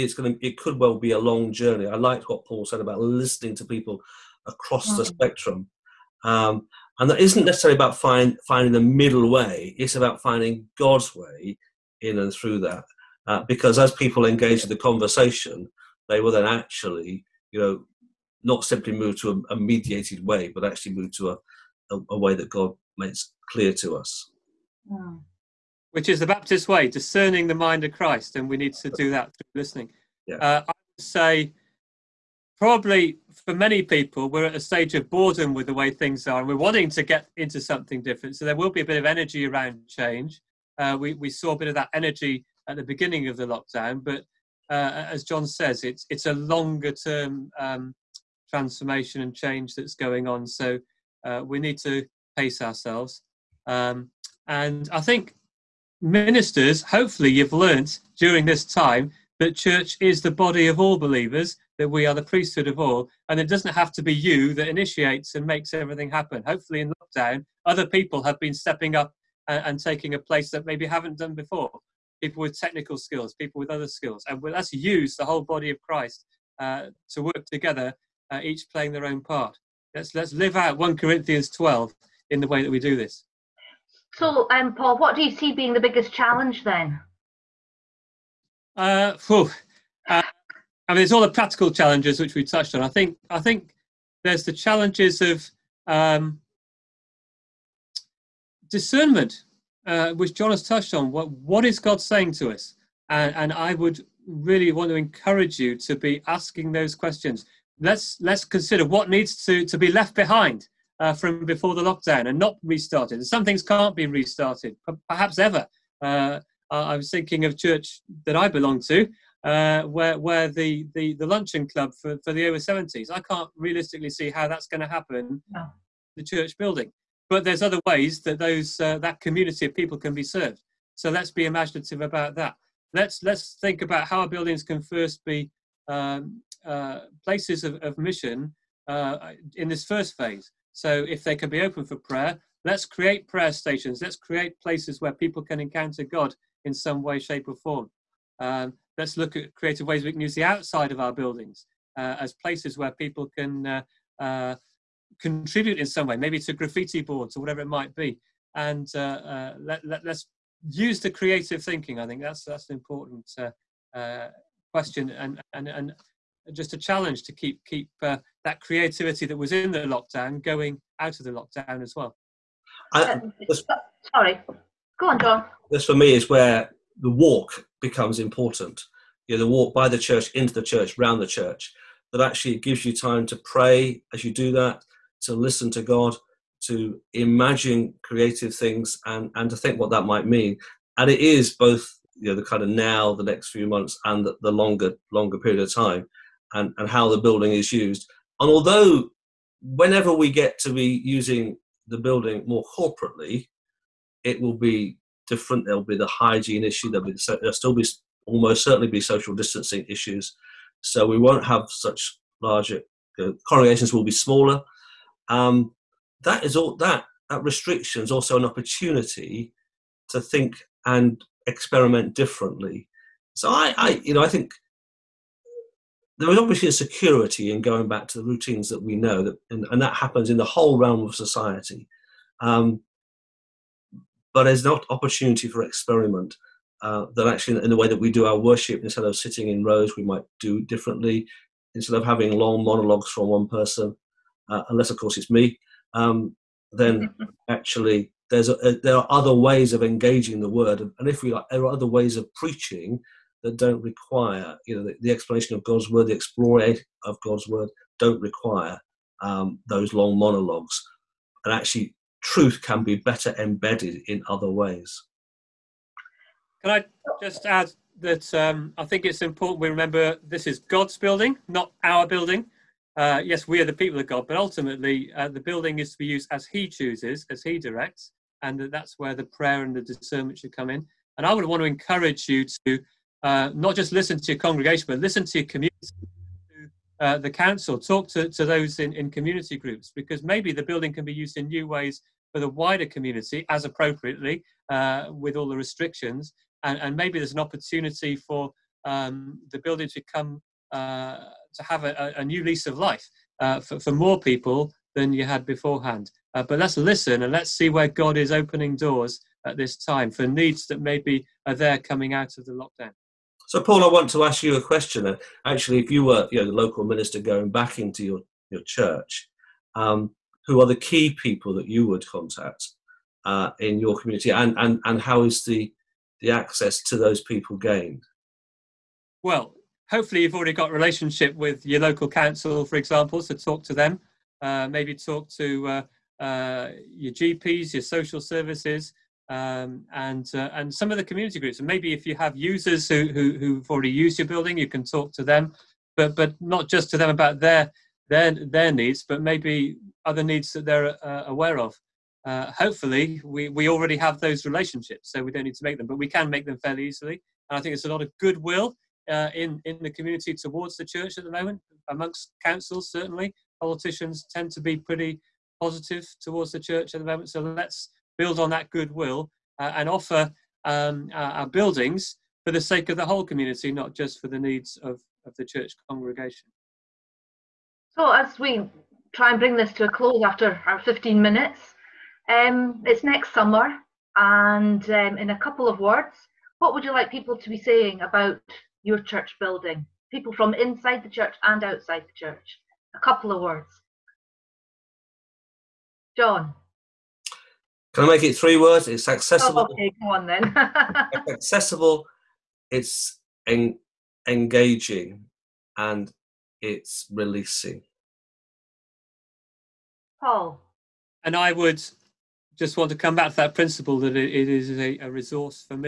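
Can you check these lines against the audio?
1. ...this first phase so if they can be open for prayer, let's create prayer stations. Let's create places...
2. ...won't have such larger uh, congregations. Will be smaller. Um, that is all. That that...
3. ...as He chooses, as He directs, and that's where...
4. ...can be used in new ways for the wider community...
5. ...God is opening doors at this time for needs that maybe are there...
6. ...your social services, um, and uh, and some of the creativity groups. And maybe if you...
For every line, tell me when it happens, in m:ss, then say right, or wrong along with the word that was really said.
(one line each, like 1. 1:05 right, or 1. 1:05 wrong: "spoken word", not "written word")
1. 2:19 right
2. 3:31 right
3. 4:36 right
4. 4:50 right
5. 5:07 right
6. 5:37 wrong: "community", not "creativity".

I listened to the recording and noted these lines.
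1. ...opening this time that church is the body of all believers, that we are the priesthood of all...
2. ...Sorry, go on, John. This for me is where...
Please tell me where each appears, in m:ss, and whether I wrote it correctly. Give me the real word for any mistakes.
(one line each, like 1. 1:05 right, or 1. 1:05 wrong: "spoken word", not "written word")
1. 0:58 wrong: "during", not "opening"
2. 2:54 right.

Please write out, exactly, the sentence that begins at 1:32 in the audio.
I think I think there's the challenges of um, discernment, uh, which John has touched on.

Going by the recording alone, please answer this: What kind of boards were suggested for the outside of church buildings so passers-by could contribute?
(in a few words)
graffiti boards.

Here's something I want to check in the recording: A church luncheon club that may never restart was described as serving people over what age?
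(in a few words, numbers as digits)
70.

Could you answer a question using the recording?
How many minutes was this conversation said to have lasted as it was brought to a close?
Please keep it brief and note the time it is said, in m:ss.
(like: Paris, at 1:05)
15, at 6:20.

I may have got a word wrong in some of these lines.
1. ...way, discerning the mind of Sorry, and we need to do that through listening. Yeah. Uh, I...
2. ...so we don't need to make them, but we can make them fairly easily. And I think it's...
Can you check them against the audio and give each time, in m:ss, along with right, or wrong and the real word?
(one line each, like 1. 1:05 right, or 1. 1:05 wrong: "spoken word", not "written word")
1. 0:26 wrong: "Christ", not "Sorry"
2. 5:55 right.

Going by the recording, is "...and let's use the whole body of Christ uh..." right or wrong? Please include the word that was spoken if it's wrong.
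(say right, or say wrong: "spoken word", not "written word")
right.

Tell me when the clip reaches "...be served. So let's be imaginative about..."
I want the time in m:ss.
2:10.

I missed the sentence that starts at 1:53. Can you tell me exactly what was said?
And some things can't be restarted, perhaps ever.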